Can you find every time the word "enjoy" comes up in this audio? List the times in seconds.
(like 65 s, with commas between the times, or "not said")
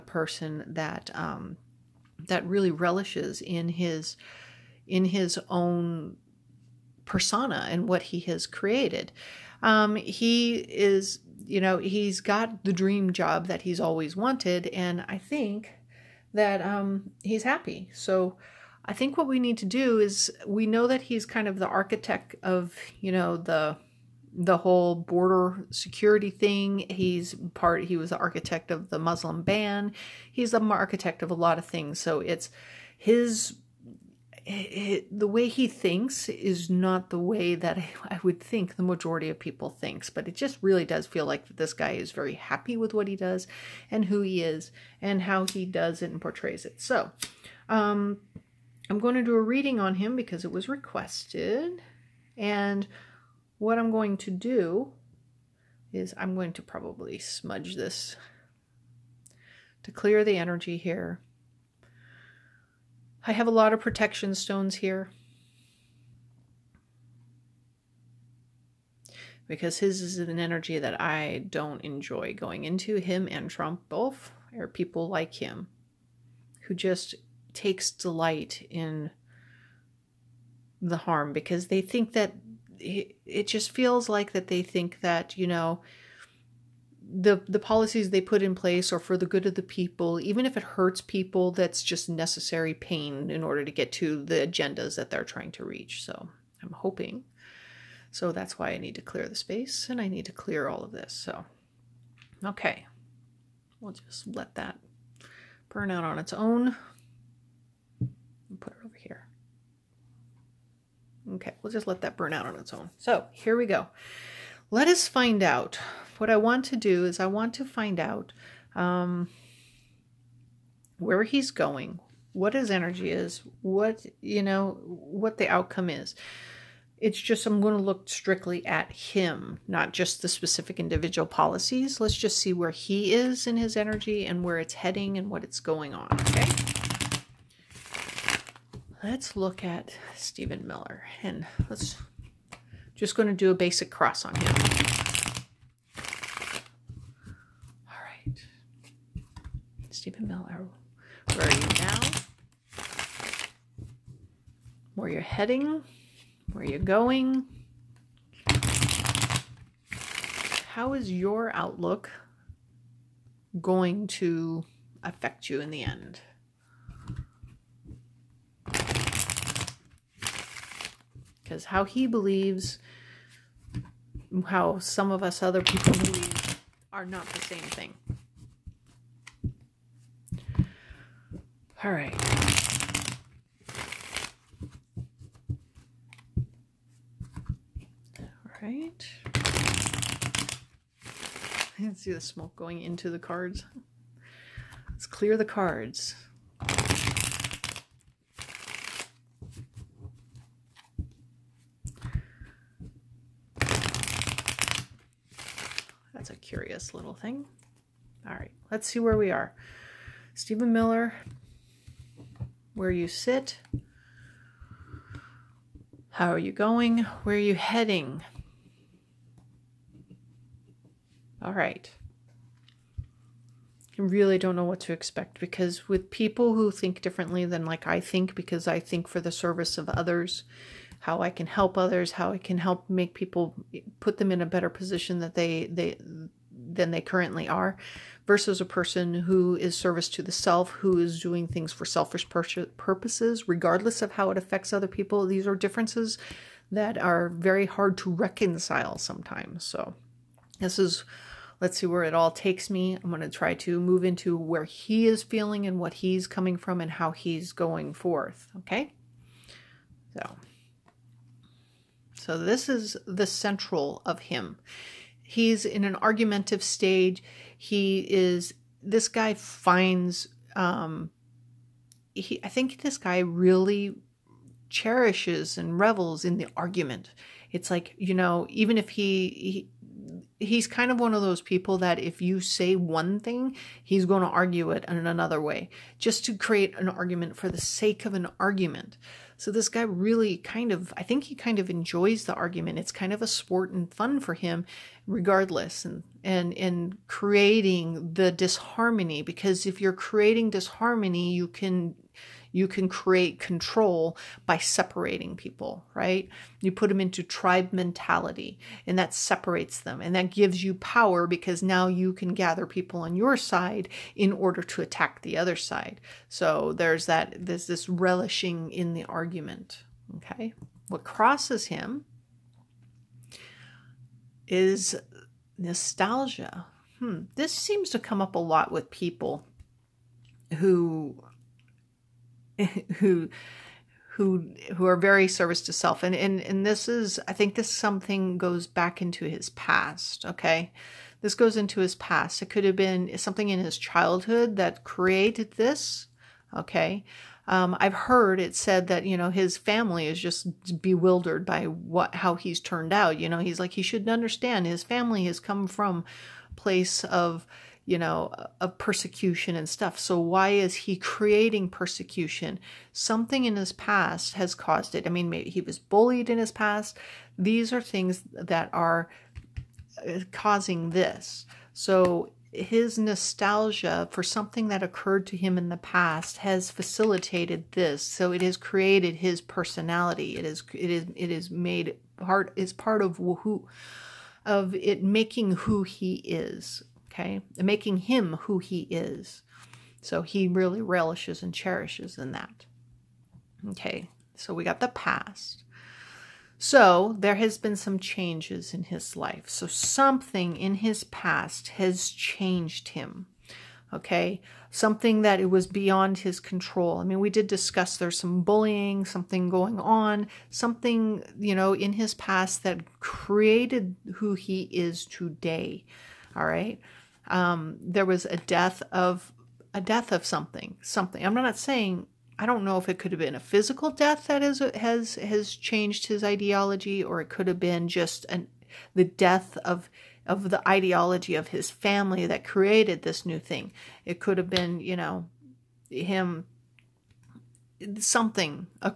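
71 s, 291 s.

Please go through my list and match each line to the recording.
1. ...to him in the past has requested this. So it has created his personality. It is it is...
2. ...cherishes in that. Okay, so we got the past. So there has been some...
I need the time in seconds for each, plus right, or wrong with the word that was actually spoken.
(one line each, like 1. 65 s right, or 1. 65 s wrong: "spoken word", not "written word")
1. 375 s wrong: "facilitated", not "requested"
2. 391 s right.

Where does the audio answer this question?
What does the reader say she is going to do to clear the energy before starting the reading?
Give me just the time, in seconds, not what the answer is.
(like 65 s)
57 s.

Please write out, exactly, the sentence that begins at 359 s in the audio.
So why is he creating persecution?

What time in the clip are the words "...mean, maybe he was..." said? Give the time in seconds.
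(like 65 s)
365 s.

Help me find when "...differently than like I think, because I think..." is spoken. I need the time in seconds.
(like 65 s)
227 s.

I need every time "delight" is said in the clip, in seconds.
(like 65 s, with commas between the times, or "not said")
77 s.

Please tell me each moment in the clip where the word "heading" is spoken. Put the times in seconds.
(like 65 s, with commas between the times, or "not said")
134 s, 155 s, 217 s.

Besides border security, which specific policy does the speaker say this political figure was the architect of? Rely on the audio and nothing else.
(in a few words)
Muslim ban.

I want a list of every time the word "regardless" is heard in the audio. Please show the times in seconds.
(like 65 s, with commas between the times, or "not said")
243 s, 295 s.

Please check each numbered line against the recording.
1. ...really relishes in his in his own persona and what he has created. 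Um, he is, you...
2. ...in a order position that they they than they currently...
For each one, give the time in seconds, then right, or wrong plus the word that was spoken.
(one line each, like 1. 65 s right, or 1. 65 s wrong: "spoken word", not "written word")
1. 2 s right
2. 234 s wrong: "better", not "order".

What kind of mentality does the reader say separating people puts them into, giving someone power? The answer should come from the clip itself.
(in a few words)
tribe mentality.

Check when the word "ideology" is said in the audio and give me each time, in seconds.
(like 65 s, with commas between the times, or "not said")
426 s, 430 s.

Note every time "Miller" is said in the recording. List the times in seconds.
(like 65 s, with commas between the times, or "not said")
140 s, 210 s.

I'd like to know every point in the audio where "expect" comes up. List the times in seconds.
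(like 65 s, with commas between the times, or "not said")
224 s.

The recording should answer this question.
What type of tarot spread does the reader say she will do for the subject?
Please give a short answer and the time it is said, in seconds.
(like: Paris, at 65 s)
basic cross, at 143 s.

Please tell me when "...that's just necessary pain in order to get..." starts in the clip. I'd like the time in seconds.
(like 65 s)
91 s.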